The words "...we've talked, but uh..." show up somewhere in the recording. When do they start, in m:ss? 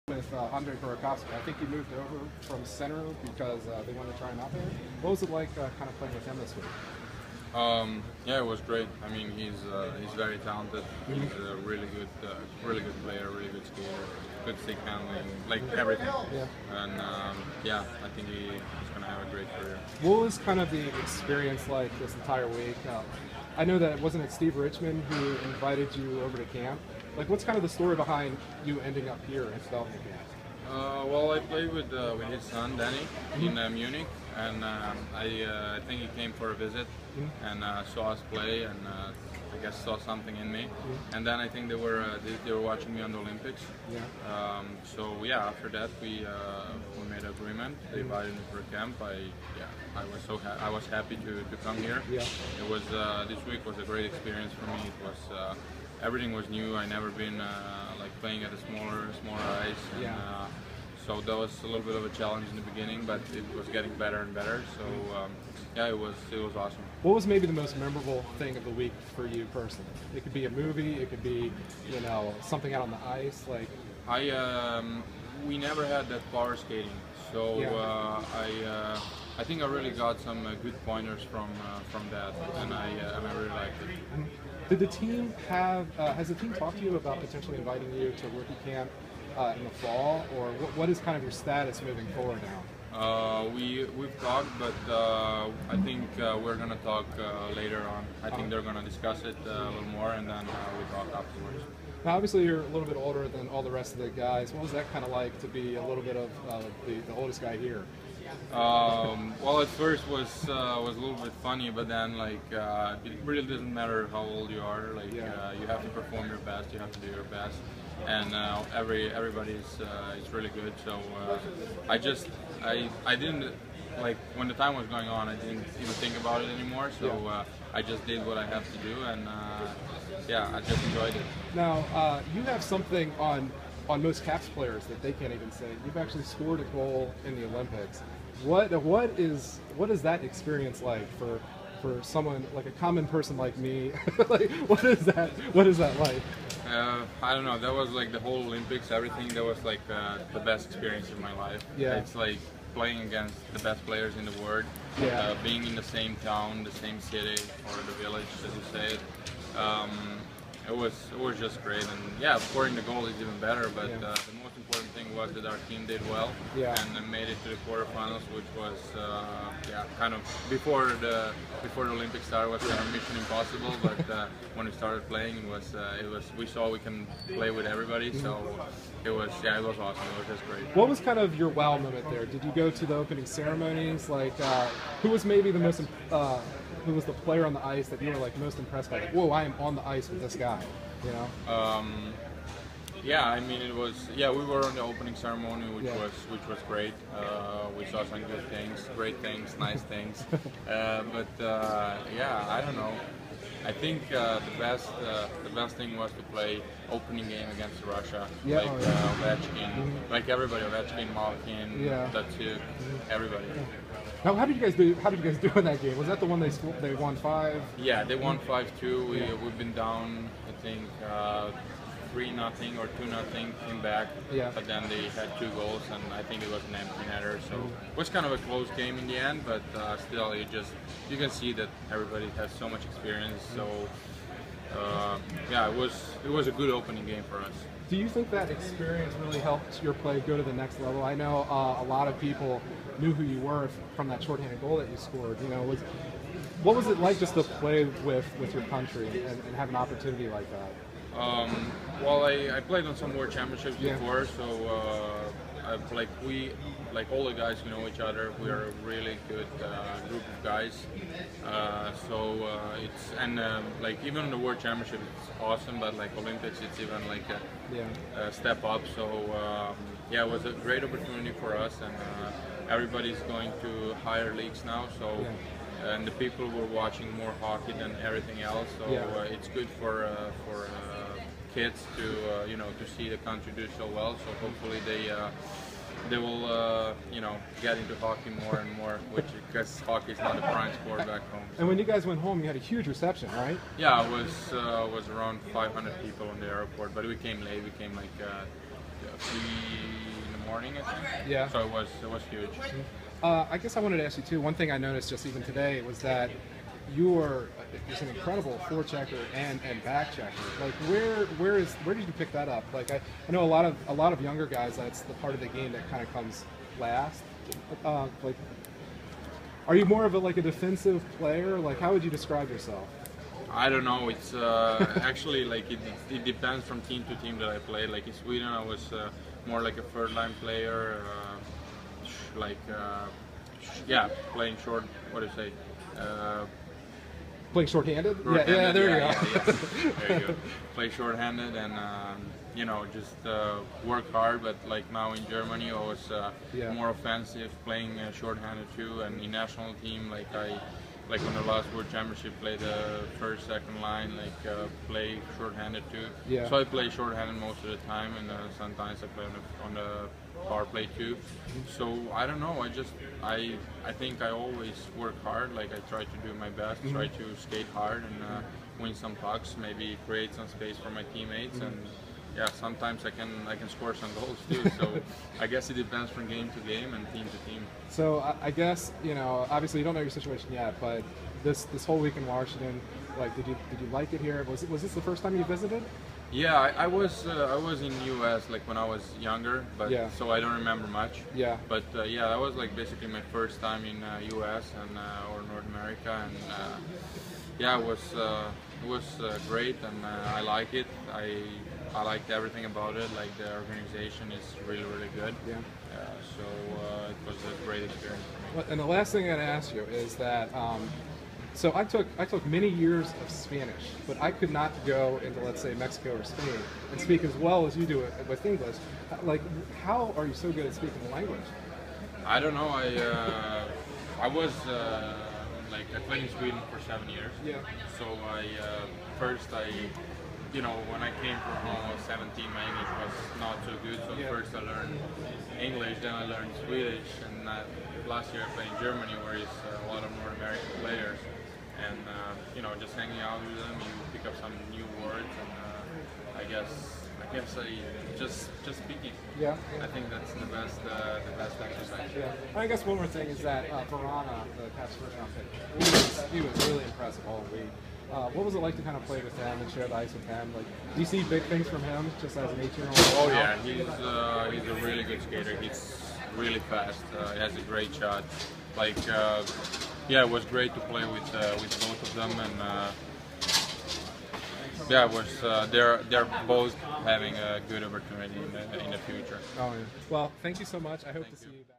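1:33.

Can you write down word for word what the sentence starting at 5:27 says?
Like in Sweden, I was uh, more like a third line player, uh, like uh, yeah, playing short.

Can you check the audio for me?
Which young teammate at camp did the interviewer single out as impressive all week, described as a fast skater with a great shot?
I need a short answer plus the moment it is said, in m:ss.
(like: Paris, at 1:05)
Vrana, at 7:33.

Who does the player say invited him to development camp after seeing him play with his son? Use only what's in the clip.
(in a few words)
Steve Richmond.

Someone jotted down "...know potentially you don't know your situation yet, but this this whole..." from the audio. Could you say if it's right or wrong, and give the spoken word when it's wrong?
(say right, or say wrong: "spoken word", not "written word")
wrong: "obviously", not "potentially".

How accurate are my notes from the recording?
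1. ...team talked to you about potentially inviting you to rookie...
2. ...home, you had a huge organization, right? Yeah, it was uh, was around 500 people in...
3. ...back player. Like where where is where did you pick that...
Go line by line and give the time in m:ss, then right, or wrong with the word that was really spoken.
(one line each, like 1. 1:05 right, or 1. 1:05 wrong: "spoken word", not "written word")
1. 1:26 right
2. 4:52 wrong: "reception", not "organization"
3. 5:09 wrong: "checker", not "player".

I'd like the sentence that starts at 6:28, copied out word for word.
like when I was younger, but yeah.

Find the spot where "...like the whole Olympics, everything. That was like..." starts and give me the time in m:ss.
2:27.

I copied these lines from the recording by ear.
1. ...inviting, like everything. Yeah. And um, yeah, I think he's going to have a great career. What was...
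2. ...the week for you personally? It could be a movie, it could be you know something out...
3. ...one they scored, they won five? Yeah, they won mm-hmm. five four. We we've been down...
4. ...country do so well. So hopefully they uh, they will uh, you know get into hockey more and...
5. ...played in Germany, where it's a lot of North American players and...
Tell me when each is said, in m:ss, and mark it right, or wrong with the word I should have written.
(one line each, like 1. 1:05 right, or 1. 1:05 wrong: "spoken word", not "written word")
1. 0:14 wrong: "handling", not "inviting"
2. 1:08 right
3. 3:36 wrong: "two", not "four"
4. 4:43 right
5. 7:18 right.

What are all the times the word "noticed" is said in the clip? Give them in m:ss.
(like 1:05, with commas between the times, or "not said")
5:04.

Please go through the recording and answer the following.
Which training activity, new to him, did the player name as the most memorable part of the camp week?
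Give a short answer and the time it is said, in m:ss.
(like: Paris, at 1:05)
Power skating, at 1:16.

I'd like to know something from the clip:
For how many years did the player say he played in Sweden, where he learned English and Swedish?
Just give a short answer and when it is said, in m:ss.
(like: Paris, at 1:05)
7, at 7:06.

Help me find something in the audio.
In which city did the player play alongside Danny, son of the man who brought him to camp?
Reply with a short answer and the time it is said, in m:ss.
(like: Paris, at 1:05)
Munich, at 0:33.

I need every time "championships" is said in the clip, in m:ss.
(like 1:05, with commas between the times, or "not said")
4:13, 4:24, 5:51.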